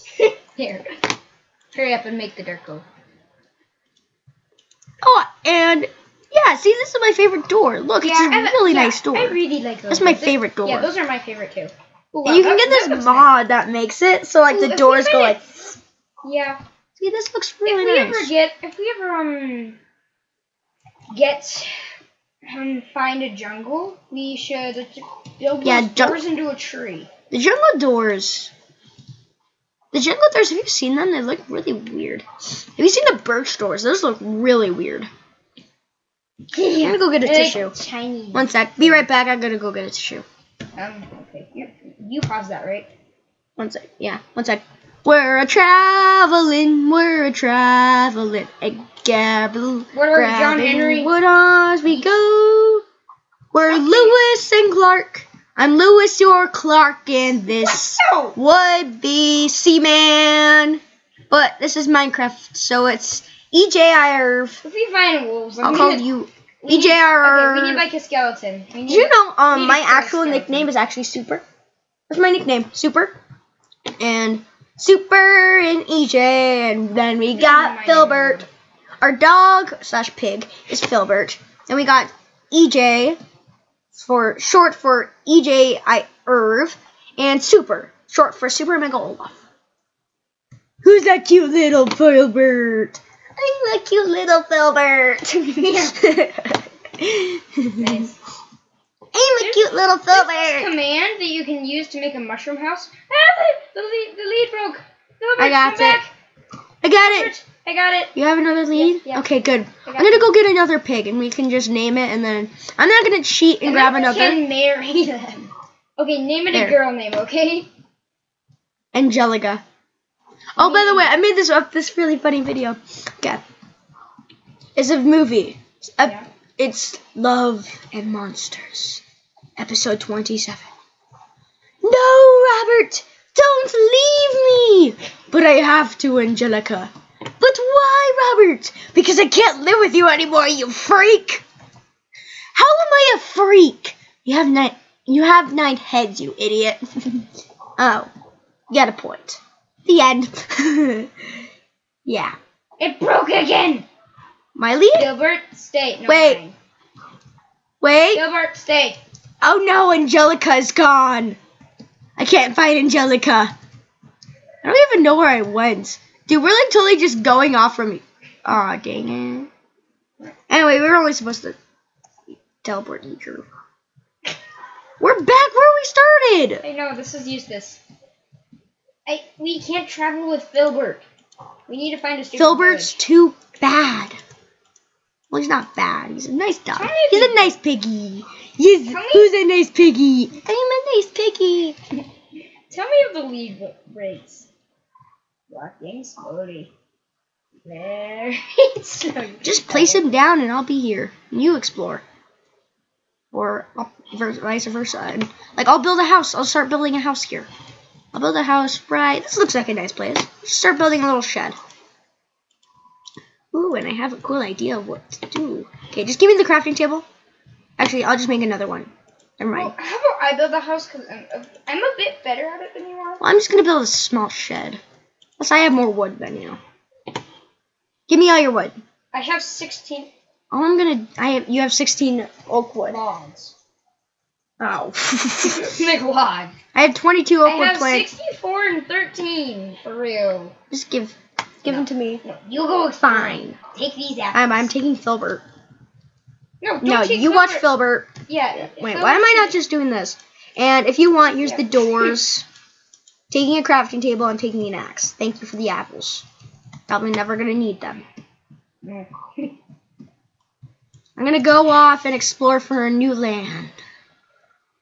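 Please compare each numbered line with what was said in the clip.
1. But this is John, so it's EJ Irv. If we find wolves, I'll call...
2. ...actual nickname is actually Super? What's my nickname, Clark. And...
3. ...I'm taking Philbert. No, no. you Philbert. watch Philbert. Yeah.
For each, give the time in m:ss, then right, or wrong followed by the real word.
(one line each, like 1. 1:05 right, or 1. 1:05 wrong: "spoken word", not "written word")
1. 1:01 wrong: "Minecraft", not "John"
2. 1:09 wrong: "Super", not "Clark"
3. 4:04 right.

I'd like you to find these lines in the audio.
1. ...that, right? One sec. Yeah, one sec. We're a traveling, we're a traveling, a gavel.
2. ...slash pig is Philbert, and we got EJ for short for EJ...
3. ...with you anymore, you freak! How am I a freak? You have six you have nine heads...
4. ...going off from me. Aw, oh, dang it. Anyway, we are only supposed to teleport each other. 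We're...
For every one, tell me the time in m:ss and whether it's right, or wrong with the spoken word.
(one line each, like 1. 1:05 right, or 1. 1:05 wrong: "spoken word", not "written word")
1. 0:42 right
2. 1:19 right
3. 2:19 wrong: "nine", not "six"
4. 2:47 right.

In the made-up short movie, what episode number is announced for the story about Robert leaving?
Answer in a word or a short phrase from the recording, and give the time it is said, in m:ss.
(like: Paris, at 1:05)
27, at 2:10.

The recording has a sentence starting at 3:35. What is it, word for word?
Okay, just give me the crafting table.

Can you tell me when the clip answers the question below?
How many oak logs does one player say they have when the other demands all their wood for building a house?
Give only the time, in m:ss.
3:49.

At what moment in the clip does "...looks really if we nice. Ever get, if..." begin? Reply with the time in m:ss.
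0:17.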